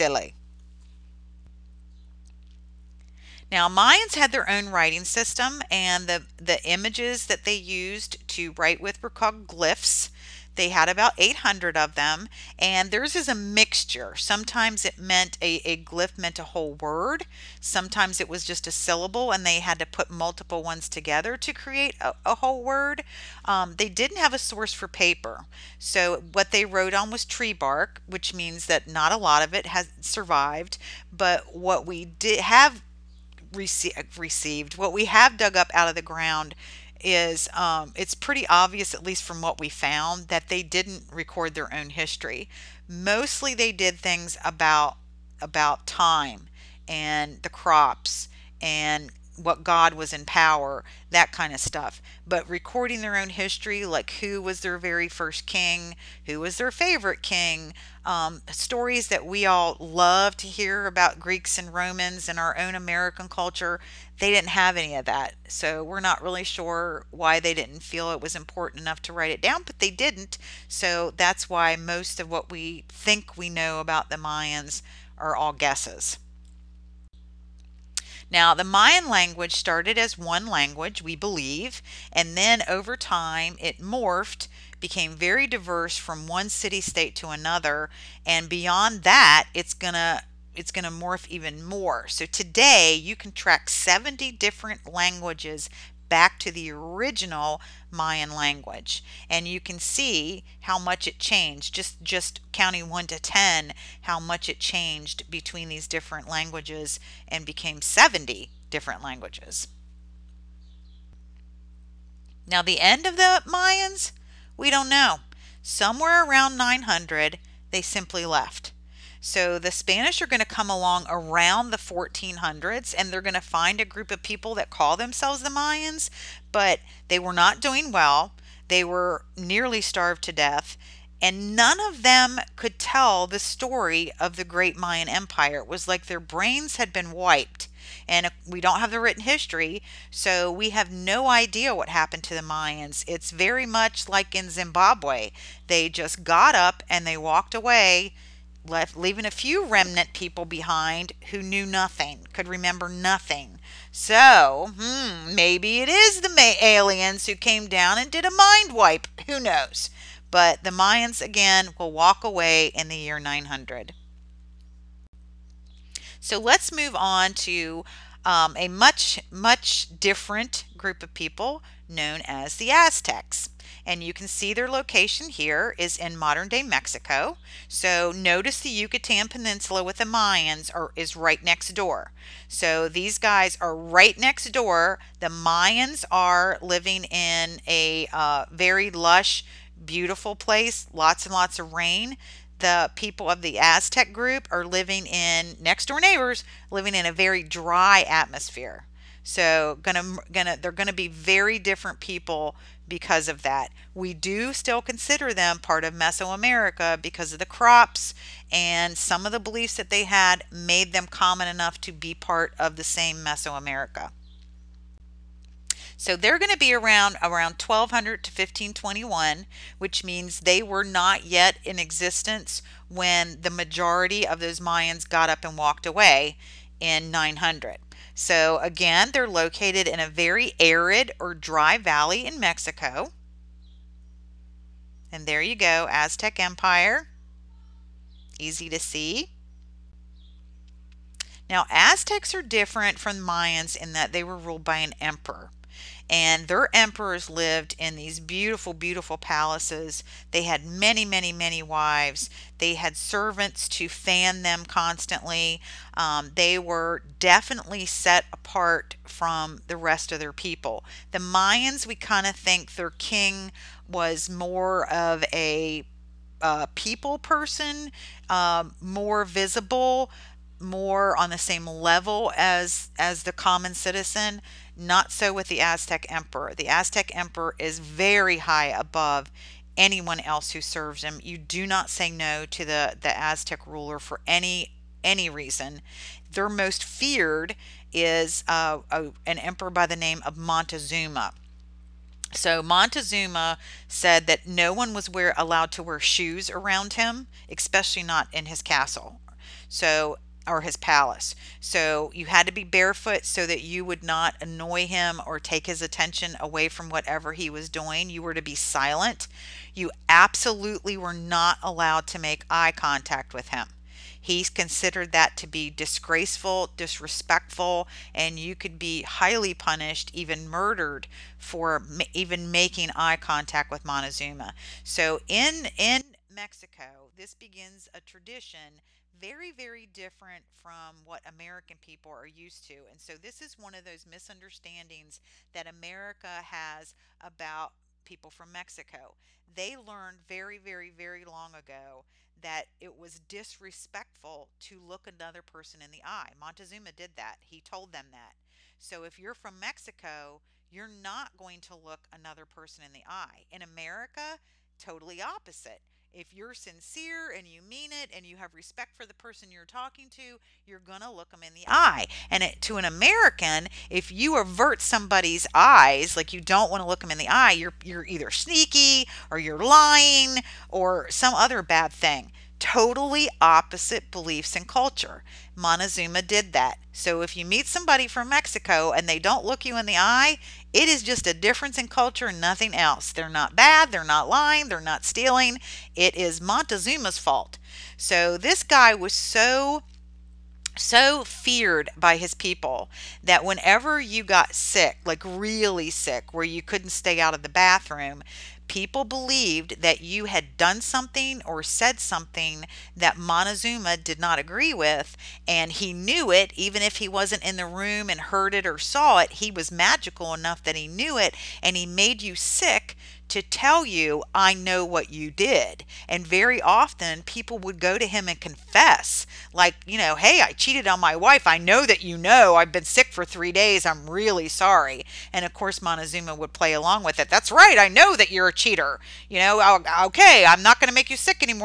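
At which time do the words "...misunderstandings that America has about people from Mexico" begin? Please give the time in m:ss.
5:34.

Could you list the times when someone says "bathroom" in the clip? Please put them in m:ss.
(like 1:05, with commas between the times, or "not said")
6:37.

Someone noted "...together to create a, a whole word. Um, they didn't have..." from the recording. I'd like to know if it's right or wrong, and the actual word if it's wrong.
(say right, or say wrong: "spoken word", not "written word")
right.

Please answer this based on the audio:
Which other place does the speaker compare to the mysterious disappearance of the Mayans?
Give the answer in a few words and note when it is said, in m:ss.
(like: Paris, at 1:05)
Zimbabwe, at 2:24.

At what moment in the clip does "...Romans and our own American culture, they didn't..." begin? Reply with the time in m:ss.
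1:01.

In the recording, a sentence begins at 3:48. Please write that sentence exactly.
So again, they're located in a very arid or dry valley in Mexico.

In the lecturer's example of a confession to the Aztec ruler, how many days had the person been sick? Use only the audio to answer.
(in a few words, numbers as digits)
3.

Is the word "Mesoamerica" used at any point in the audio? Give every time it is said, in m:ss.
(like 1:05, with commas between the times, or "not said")
3:25, 3:33.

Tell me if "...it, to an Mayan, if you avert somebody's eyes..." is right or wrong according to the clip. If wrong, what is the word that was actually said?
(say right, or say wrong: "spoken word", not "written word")
wrong: "American", not "Mayan".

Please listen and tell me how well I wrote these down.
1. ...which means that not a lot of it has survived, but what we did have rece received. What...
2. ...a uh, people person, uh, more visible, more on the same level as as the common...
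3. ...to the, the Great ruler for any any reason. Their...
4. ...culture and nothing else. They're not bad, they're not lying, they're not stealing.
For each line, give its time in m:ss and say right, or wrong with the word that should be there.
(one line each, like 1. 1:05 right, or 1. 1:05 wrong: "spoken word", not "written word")
1. 0:28 right
2. 4:25 right
3. 4:42 wrong: "Aztec", not "Great"
4. 6:21 right.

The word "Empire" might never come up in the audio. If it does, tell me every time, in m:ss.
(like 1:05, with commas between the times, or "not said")
2:15, 3:56.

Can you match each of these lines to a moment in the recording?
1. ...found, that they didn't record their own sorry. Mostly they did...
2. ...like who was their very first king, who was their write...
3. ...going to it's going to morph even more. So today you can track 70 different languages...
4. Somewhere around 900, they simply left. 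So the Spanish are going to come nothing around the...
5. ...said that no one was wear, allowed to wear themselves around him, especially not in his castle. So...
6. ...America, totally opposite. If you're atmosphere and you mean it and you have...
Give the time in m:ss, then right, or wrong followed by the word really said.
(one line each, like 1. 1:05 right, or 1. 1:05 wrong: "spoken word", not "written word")
1. 0:39 wrong: "history", not "sorry"
2. 0:53 wrong: "favorite", not "write"
3. 1:29 right
4. 1:55 wrong: "along", not "nothing"
5. 4:53 wrong: "shoes", not "themselves"
6. 5:53 wrong: "sincere", not "atmosphere".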